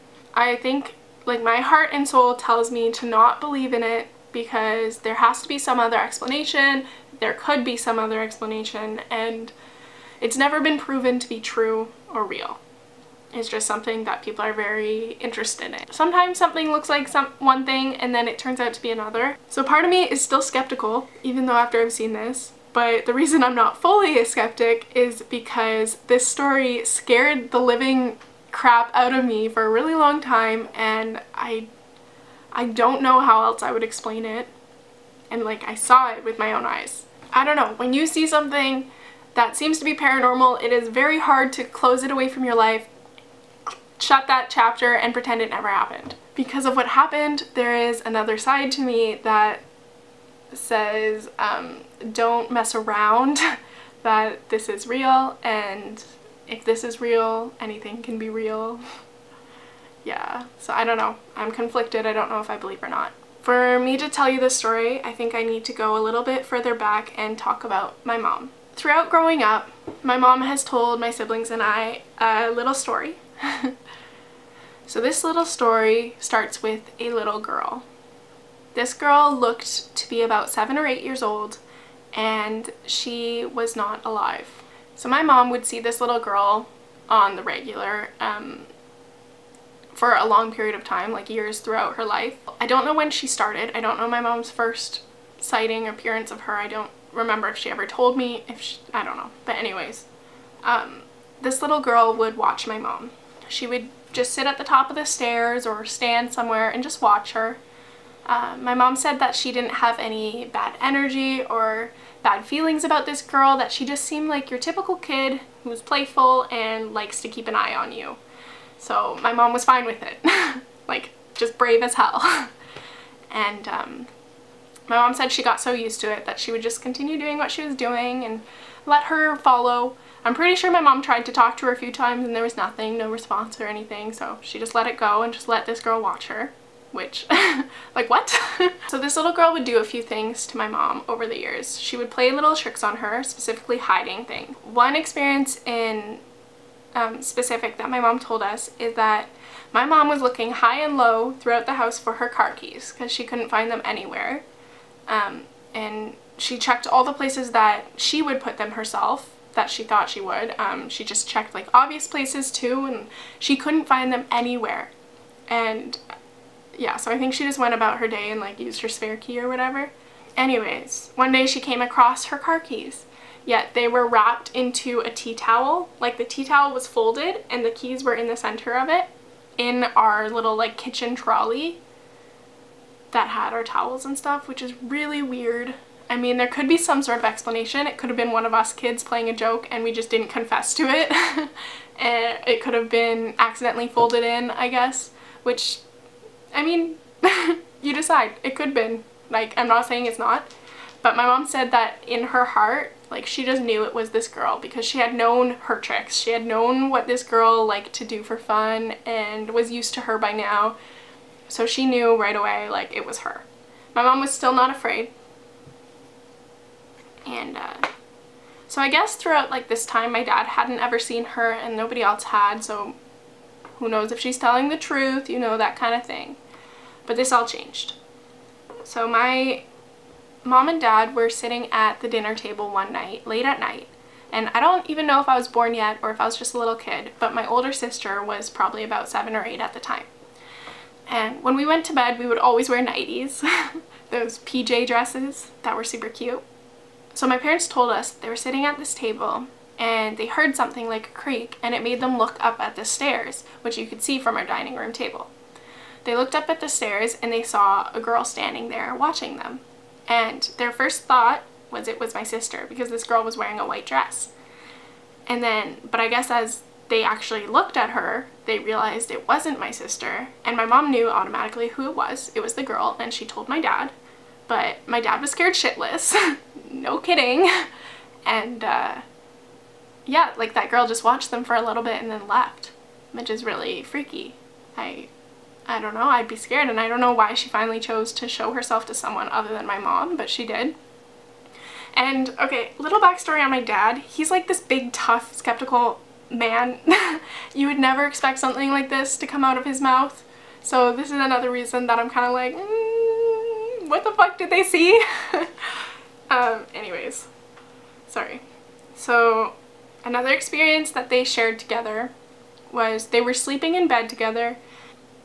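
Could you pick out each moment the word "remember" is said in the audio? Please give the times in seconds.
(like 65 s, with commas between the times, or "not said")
97 s.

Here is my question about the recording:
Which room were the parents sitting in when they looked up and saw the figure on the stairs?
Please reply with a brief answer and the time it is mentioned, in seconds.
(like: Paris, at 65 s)
dining room, at 254 s.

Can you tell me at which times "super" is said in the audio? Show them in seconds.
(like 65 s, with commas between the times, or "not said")
245 s.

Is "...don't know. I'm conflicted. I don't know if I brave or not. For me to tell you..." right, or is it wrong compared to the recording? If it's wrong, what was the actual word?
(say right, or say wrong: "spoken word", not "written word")
wrong: "believe", not "brave".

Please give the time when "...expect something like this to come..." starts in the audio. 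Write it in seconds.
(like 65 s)
298 s.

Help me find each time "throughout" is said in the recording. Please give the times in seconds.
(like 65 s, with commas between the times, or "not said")
68 s, 91 s, 151 s, 219 s.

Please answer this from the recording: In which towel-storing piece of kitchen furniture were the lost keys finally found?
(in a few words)
kitchen trolley.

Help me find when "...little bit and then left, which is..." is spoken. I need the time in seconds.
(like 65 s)
281 s.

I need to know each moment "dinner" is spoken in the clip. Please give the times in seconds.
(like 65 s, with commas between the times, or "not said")
232 s.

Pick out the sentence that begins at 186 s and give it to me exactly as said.
I mean, there could be some sort of explanation.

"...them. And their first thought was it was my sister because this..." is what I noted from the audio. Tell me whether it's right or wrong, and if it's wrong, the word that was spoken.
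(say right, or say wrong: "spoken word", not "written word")
right.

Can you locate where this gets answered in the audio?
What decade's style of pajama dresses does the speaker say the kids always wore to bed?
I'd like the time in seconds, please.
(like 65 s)
242 s.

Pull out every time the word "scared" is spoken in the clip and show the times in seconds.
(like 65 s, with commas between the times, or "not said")
26 s, 275 s, 286 s.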